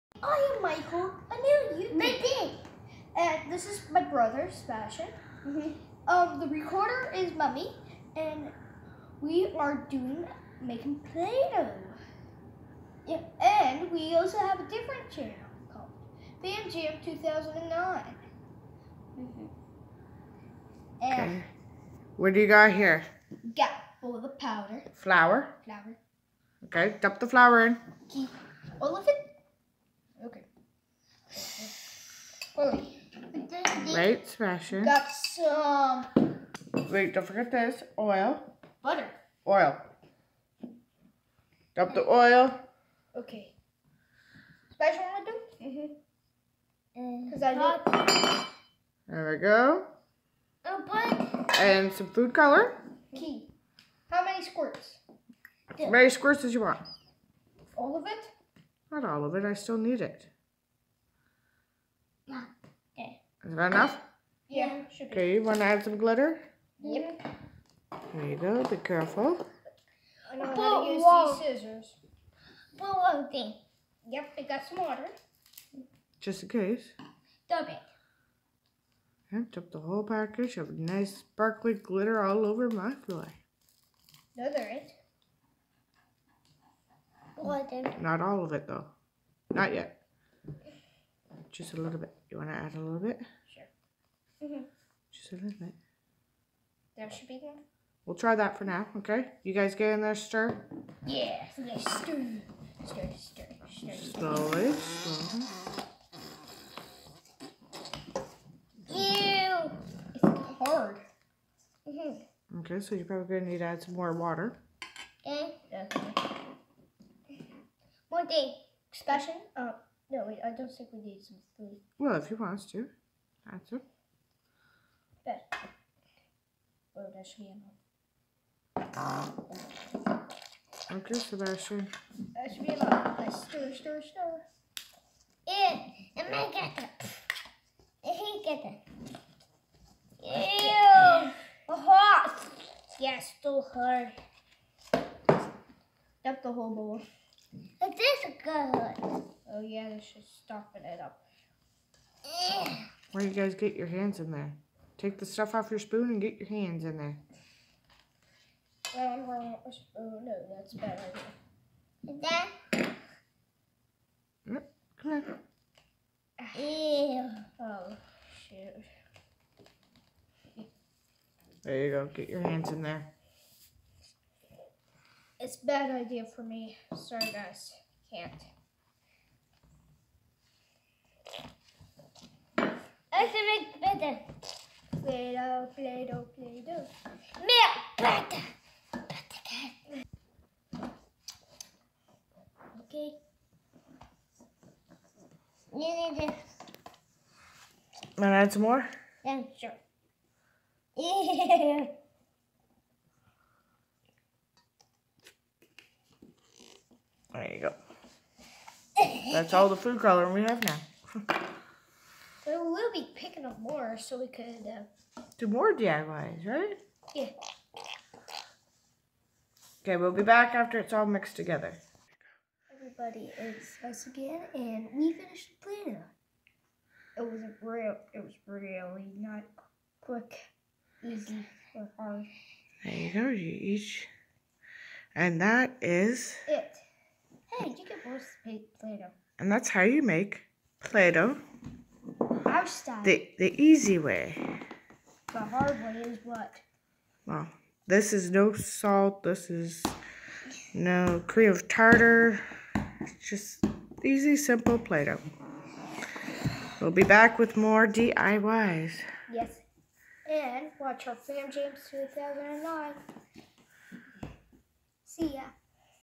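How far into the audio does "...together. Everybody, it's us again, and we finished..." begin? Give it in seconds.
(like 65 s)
221 s.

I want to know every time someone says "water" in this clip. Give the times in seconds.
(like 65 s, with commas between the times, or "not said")
74 s, 114 s.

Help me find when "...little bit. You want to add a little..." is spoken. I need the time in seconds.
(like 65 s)
91 s.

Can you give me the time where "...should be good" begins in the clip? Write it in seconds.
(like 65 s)
97 s.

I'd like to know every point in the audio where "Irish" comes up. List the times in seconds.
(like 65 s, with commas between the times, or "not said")
not said.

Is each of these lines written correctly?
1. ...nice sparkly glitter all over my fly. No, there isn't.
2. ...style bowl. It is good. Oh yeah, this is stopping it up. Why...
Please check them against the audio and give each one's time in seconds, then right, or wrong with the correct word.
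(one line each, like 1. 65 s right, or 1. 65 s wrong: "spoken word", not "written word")
1. 80 s right
2. 146 s wrong: "whole", not "style".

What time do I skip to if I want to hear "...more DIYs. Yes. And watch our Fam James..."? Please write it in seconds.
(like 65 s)
257 s.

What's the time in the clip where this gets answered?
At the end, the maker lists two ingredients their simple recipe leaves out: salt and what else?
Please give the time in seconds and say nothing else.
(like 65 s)
251 s.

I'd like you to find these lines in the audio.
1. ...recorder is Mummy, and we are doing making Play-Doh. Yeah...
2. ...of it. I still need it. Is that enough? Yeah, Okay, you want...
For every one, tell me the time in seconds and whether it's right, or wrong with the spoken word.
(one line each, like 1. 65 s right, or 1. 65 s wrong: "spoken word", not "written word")
1. 6 s right
2. 59 s right.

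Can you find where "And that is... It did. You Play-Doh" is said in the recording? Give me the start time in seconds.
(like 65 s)
235 s.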